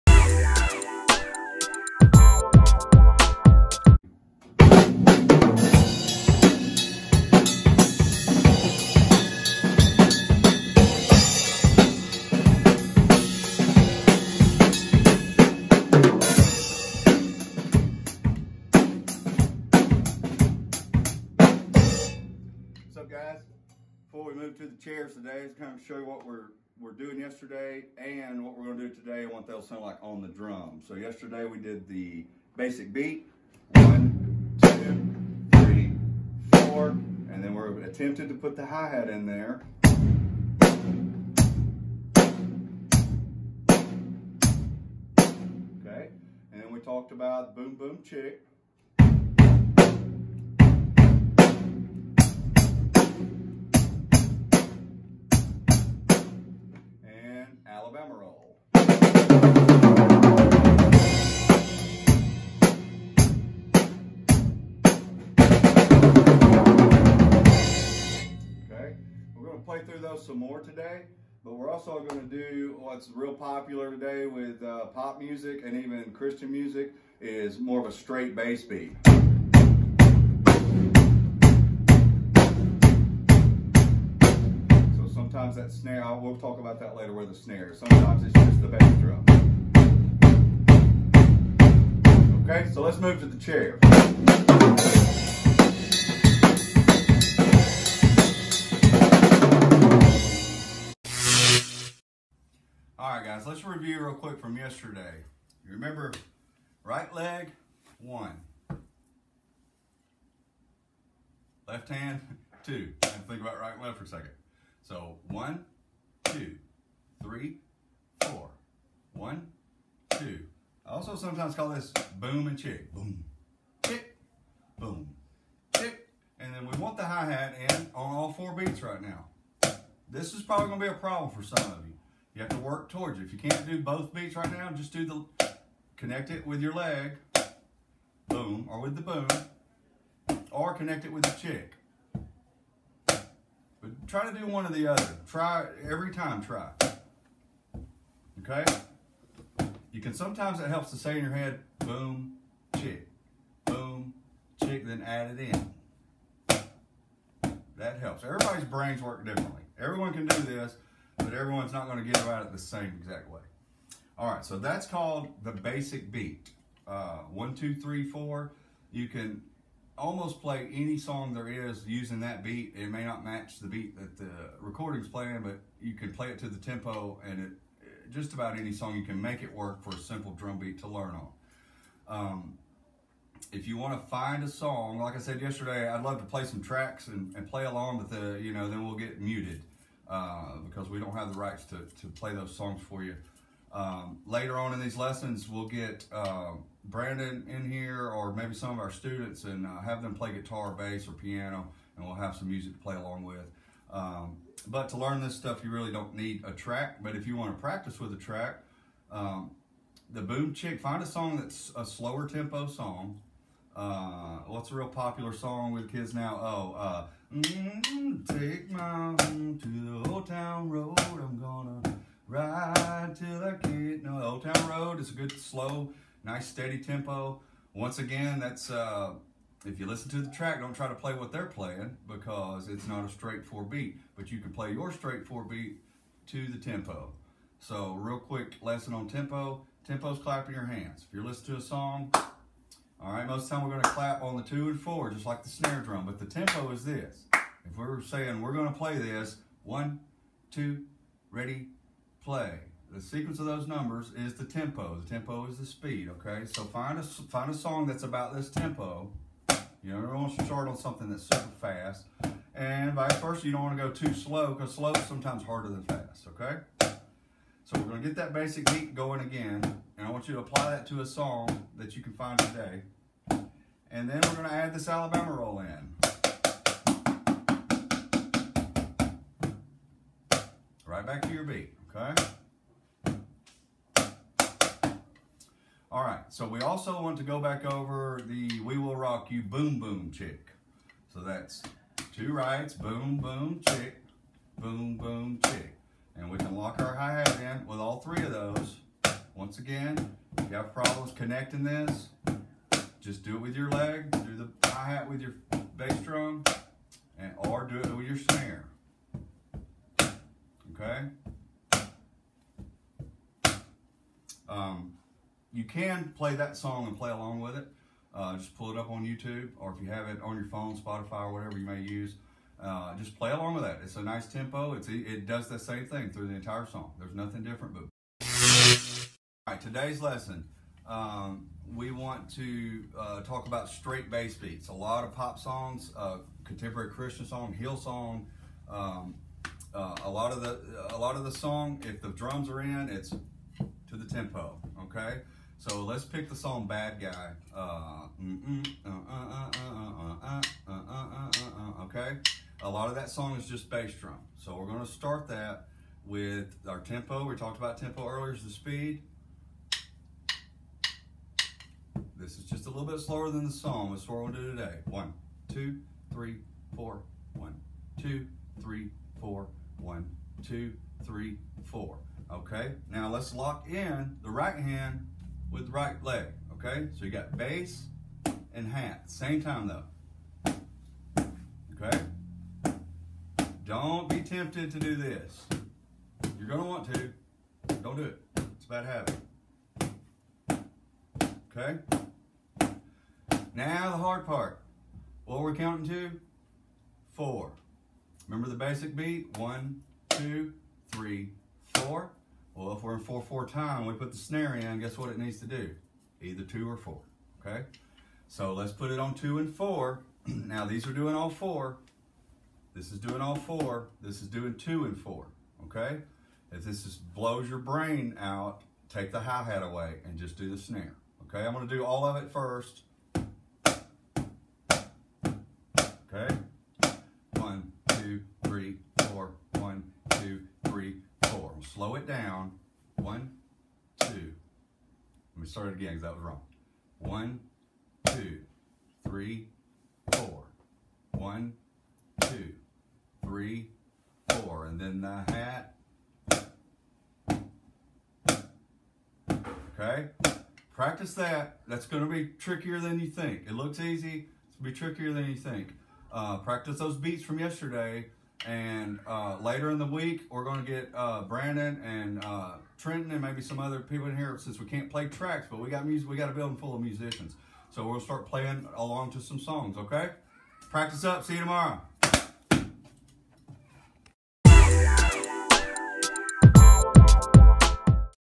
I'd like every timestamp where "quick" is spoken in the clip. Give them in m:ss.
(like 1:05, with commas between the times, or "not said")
1:44, 3:58.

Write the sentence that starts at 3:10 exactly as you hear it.
Uh, because we don't have the rights to, to play those songs for you.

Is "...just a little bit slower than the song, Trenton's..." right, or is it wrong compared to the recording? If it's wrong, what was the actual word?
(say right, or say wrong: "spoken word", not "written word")
wrong: "That", not "Trenton".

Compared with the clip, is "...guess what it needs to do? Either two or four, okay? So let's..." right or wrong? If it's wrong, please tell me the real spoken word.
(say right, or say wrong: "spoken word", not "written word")
right.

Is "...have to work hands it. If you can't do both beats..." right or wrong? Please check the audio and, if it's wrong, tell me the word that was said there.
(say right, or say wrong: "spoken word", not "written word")
wrong: "towards", not "hands".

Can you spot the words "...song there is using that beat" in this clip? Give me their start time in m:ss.
2:50.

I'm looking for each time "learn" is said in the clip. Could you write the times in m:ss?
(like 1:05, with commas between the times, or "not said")
3:00, 3:24.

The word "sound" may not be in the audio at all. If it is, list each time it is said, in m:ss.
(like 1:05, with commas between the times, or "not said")
0:29.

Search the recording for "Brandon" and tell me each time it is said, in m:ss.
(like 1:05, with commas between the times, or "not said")
3:16, 7:41.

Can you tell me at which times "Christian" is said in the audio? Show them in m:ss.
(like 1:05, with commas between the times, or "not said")
1:16, 5:36.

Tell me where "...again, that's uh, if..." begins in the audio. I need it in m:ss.
3:47.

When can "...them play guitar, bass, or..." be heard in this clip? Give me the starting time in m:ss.
3:20.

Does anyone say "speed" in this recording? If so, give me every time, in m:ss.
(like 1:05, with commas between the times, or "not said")
4:15, 5:58.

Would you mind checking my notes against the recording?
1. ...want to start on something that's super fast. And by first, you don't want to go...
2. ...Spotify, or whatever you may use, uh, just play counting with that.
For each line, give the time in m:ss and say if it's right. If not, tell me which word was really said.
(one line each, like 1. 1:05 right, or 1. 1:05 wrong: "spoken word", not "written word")
1. 4:20 right
2. 5:20 wrong: "along", not "counting".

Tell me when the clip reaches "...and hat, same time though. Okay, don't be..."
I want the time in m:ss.
6:18.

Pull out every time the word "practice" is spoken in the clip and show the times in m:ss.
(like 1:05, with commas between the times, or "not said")
3:27, 7:30, 7:36, 7:50.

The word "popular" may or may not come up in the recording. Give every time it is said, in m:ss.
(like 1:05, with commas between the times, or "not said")
1:13, 3:34.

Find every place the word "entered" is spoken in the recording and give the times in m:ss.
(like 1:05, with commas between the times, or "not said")
not said.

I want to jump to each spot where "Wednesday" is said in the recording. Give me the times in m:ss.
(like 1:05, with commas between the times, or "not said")
not said.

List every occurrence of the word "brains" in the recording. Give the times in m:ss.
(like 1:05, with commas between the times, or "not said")
2:38, 6:57.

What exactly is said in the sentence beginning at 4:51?
So that's two rights, boom, boom, chick, boom, boom, chick.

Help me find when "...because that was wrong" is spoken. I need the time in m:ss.
7:15.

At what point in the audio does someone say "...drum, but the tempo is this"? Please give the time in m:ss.
4:05.